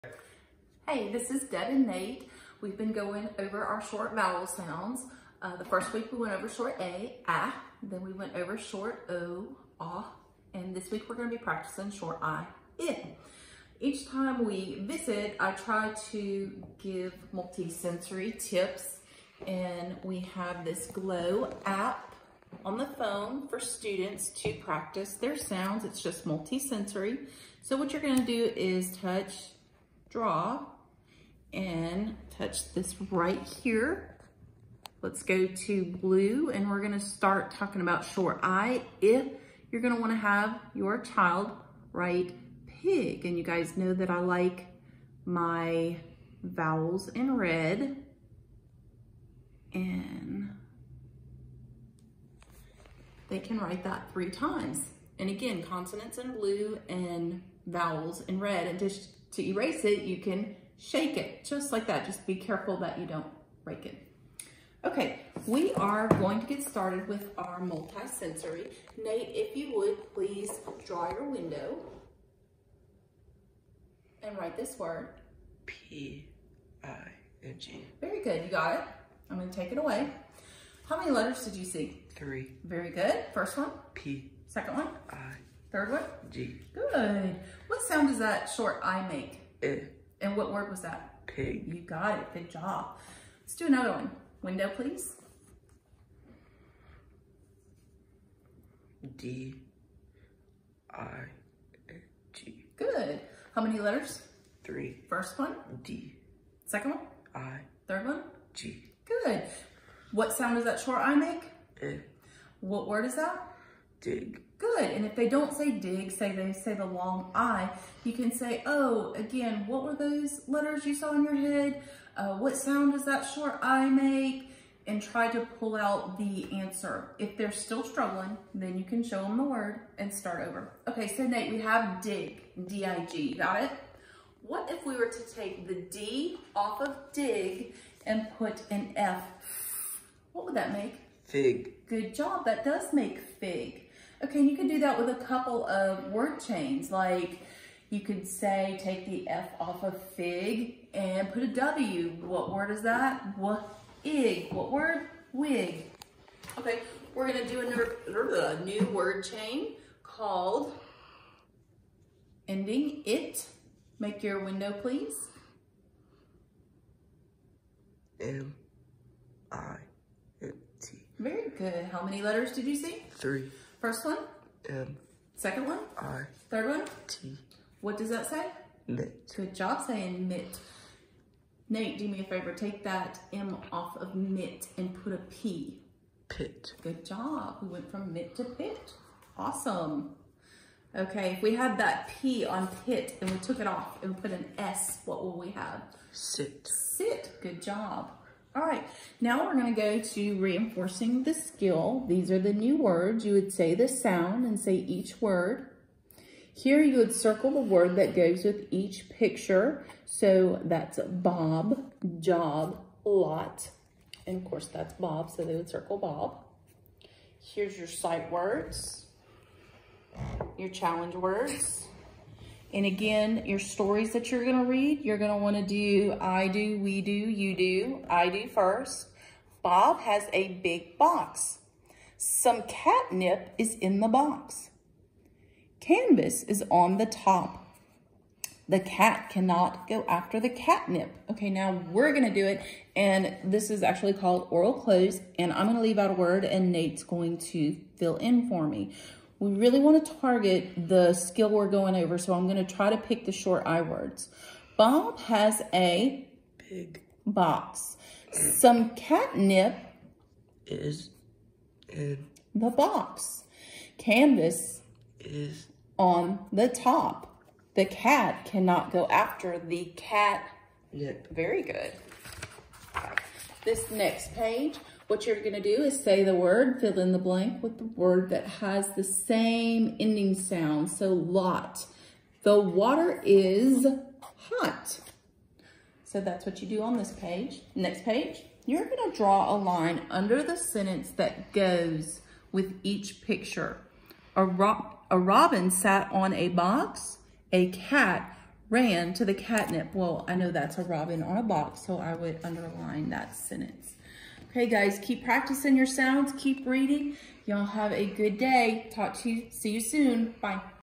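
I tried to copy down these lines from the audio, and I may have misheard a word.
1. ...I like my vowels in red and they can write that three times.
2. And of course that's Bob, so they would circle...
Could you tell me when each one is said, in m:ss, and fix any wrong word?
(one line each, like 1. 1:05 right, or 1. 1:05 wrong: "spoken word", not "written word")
1. 0:44 right
2. 3:34 right.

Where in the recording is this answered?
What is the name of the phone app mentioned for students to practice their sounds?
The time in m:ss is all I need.
0:20.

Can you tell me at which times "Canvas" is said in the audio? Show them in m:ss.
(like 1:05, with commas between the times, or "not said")
3:55, 4:23.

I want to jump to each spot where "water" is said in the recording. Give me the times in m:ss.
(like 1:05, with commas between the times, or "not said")
4:42.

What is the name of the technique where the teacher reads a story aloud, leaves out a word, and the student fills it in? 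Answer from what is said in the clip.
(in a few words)
Oral cloze.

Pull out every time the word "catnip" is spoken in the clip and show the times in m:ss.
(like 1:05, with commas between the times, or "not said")
3:52, 4:00, 4:18, 4:59.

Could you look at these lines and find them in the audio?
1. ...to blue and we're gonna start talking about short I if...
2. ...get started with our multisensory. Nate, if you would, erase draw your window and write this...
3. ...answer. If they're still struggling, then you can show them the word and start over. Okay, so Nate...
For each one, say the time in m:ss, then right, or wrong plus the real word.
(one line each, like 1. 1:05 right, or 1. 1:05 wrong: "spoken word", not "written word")
1. 0:35 right
2. 1:06 wrong: "please", not "erase"
3. 2:06 right.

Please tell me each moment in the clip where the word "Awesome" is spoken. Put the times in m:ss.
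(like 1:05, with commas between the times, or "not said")
3:09.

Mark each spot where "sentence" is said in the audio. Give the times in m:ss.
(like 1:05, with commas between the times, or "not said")
4:50, 5:03.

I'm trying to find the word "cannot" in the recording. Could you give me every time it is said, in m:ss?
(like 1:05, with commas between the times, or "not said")
3:59, 4:28.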